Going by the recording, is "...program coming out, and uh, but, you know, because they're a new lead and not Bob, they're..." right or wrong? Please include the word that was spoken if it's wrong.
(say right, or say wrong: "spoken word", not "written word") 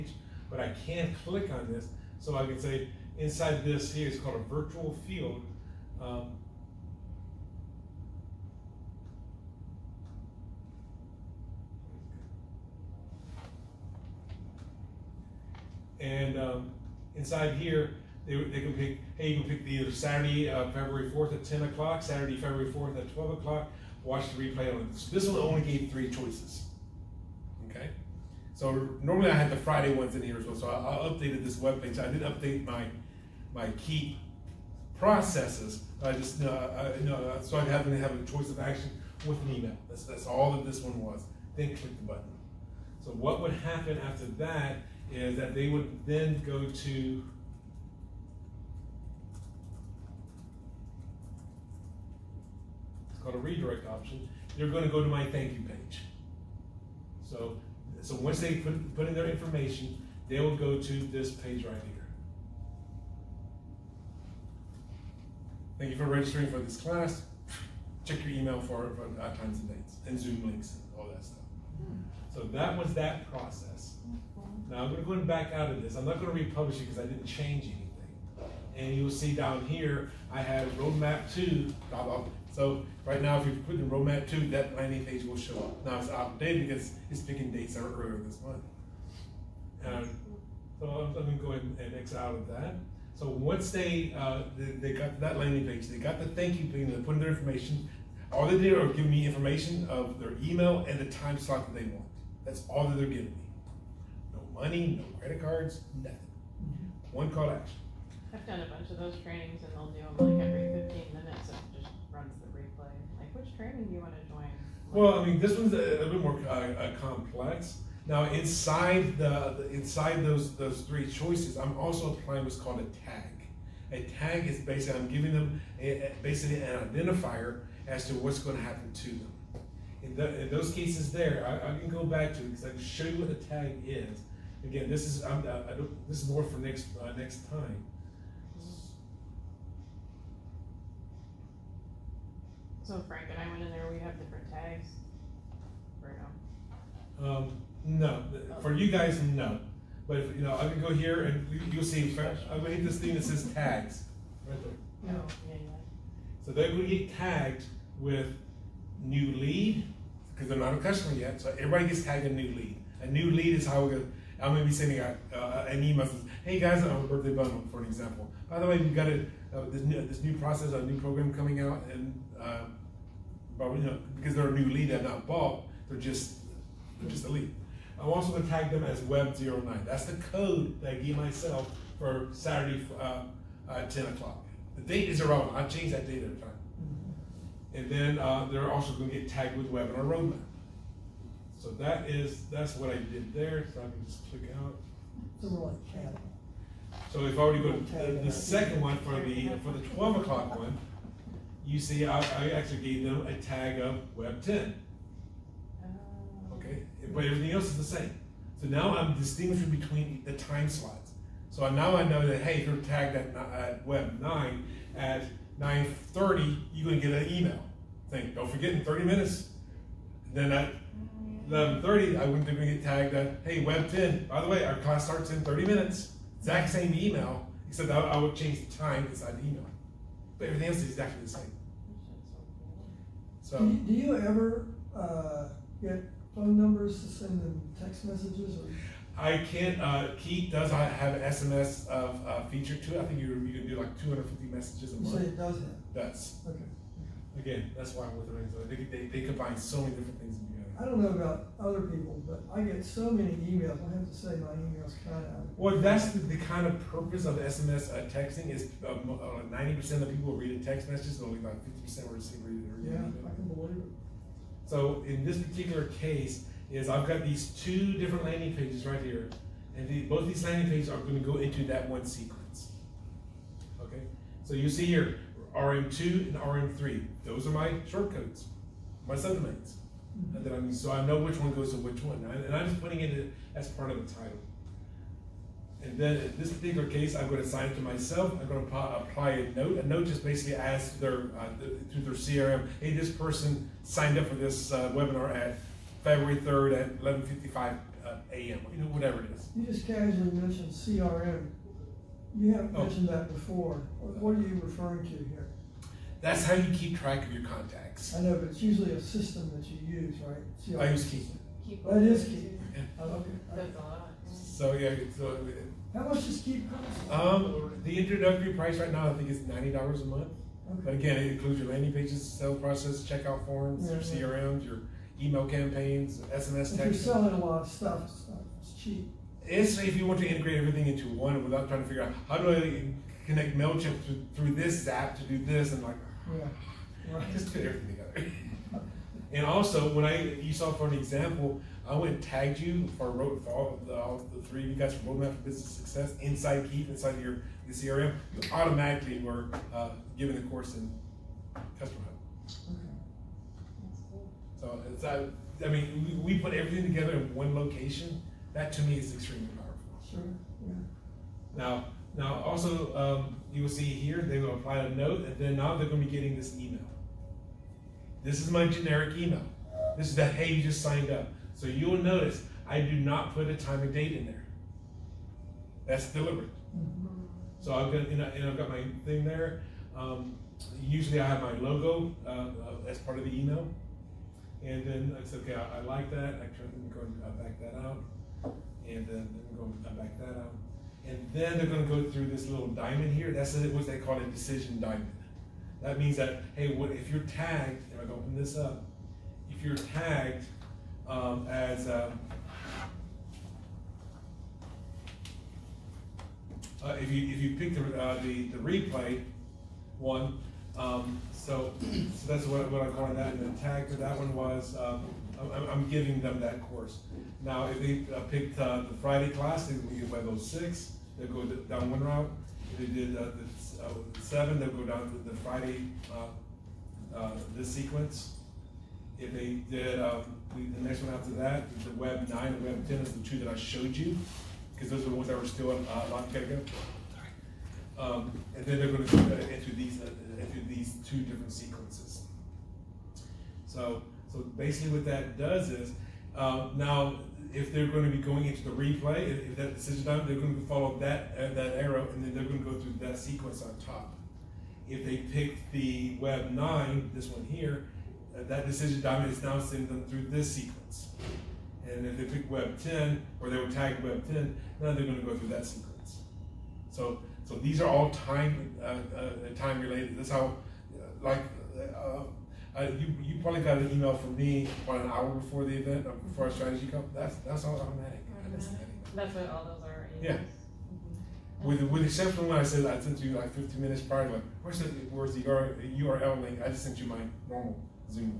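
right.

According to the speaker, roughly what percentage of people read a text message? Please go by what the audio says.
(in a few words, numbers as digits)
90 percent.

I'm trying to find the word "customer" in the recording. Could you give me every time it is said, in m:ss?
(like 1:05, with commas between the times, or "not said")
2:40, 5:51.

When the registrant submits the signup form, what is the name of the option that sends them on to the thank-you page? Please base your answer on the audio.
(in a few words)
redirect option.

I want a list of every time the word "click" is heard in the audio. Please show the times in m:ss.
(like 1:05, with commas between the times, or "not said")
0:01, 0:41, 3:14.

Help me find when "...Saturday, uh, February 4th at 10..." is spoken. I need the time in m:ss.
0:19.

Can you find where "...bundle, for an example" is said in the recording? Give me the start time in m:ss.
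2:47.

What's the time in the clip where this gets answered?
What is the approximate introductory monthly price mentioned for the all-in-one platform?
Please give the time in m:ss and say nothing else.
5:19.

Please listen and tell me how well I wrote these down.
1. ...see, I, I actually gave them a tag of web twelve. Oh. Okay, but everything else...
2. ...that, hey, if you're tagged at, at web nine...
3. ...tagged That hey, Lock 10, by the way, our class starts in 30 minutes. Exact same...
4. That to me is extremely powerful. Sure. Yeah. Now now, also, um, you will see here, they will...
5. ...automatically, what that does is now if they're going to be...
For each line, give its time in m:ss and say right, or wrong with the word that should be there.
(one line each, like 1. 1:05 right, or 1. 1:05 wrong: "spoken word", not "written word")
1. 3:21 wrong: "ten", not "twelve"
2. 3:32 right
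3. 3:42 wrong: "Web", not "Lock"
4. 5:58 right
5. 7:24 wrong: "basically", not "automatically".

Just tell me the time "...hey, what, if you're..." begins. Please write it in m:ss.
6:36.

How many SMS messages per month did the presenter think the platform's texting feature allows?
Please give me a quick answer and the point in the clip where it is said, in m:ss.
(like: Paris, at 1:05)
250, at 4:03.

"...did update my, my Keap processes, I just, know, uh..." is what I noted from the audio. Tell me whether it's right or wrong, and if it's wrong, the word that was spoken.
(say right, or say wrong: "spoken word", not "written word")
right.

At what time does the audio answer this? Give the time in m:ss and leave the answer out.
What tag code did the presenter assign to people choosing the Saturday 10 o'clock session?
2:59.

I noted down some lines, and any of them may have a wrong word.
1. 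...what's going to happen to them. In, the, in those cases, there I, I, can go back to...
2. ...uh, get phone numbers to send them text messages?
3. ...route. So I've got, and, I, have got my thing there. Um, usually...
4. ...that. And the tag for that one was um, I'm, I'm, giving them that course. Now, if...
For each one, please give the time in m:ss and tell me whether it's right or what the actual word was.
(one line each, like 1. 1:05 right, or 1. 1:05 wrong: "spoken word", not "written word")
1. 2:08 right
2. 3:54 right
3. 6:16 wrong: "deliberate", not "route"
4. 6:53 right.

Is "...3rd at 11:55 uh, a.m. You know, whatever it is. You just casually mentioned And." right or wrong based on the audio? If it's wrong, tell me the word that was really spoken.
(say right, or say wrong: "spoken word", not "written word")
wrong: "CRM", not "And".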